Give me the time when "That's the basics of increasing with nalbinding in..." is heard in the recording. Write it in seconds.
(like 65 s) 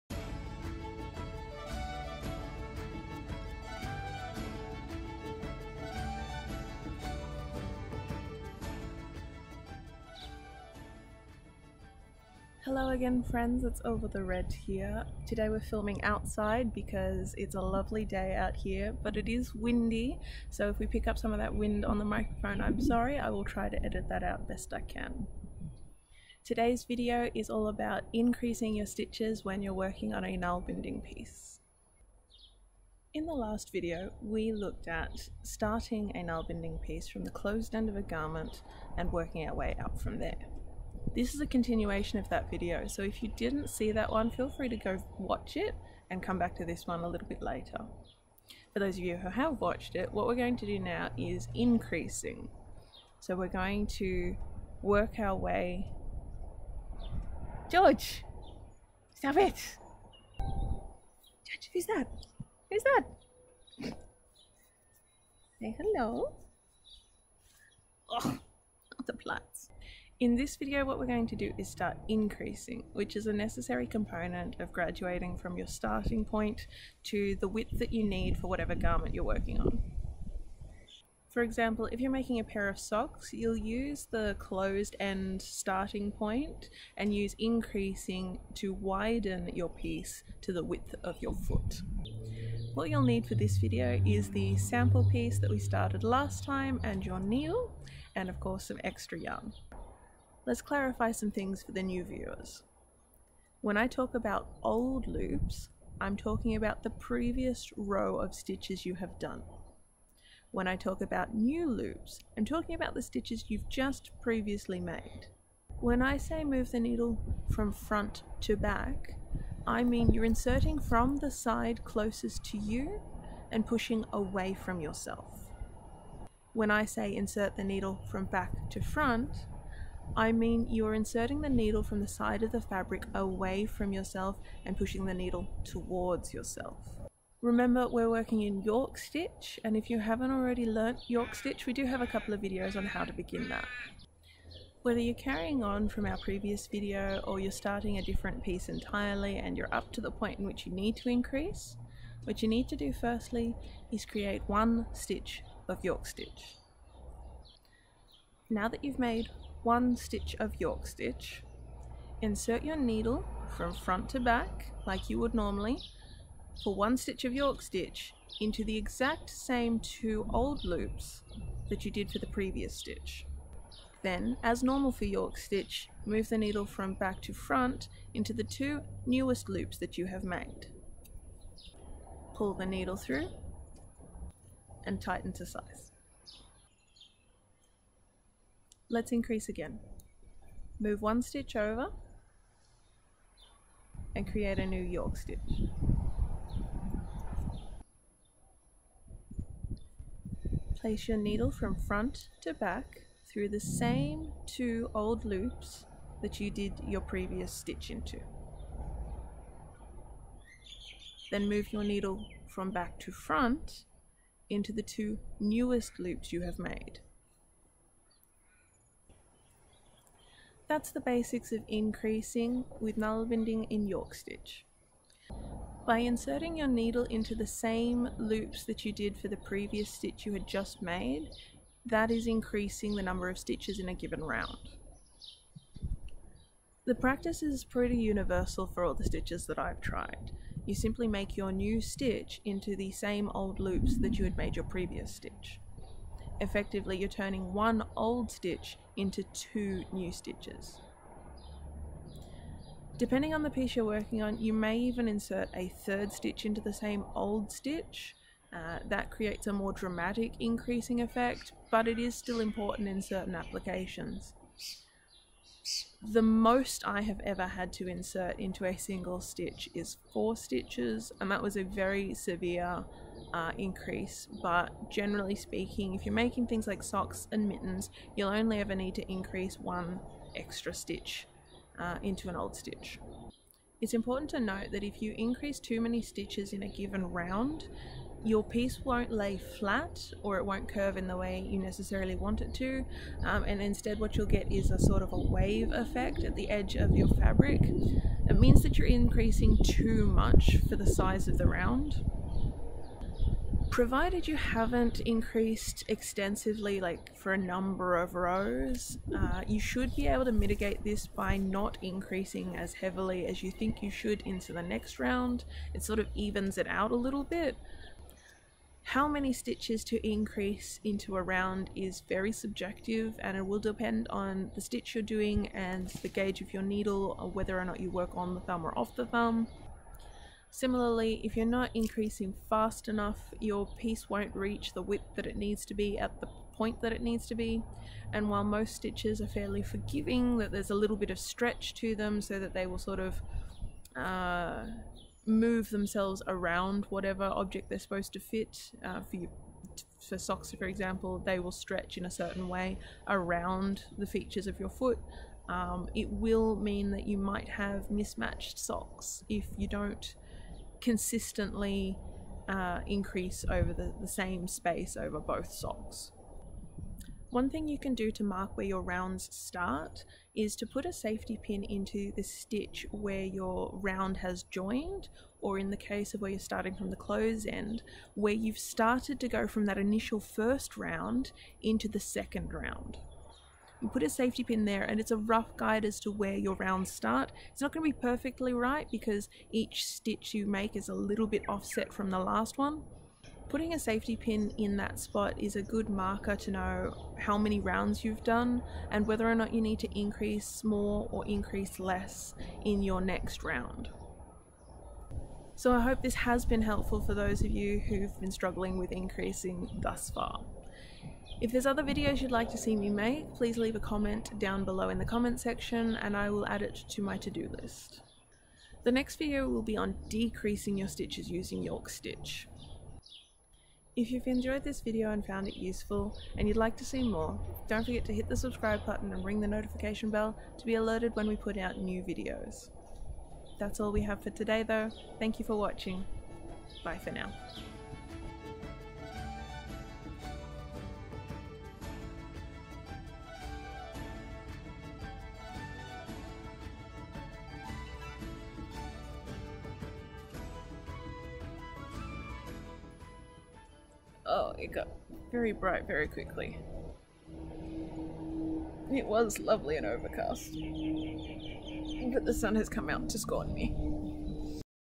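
220 s.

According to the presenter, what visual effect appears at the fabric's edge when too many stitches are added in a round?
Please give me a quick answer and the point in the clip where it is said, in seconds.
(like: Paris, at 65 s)
wave effect, at 295 s.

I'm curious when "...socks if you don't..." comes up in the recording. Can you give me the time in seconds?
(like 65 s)
358 s.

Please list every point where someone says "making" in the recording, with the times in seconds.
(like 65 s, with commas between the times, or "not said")
82 s, 276 s.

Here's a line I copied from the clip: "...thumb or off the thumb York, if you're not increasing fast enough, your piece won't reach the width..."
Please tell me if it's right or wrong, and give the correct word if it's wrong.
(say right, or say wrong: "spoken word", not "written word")
wrong: "Similarly", not "York".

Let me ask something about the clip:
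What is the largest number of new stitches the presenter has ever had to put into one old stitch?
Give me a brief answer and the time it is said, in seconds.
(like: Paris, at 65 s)
4, at 270 s.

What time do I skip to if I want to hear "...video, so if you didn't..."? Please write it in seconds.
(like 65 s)
42 s.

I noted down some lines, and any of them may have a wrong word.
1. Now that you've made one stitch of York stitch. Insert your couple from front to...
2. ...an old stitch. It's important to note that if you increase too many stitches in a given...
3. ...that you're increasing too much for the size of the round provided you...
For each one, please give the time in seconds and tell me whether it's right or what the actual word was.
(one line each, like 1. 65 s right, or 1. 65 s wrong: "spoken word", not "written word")
1. 158 s wrong: "needle", not "couple"
2. 282 s right
3. 298 s right.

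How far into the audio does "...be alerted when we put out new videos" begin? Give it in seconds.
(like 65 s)
430 s.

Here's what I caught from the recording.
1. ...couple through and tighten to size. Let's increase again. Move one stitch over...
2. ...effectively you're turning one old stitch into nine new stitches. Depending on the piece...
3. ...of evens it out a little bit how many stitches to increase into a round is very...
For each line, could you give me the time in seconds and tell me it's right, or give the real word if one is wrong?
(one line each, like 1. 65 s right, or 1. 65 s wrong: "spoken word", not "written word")
1. 182 s wrong: "needle", not "couple"
2. 246 s wrong: "two", not "nine"
3. 315 s right.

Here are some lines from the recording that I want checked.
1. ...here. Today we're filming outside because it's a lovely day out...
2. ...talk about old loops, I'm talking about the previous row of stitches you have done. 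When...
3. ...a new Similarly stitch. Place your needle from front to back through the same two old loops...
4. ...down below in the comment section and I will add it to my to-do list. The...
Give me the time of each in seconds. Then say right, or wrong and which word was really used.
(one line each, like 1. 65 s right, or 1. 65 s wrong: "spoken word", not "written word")
1. 14 s right
2. 103 s right
3. 194 s wrong: "York", not "Similarly"
4. 414 s right.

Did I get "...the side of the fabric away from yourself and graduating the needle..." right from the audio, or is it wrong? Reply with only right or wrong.
wrong.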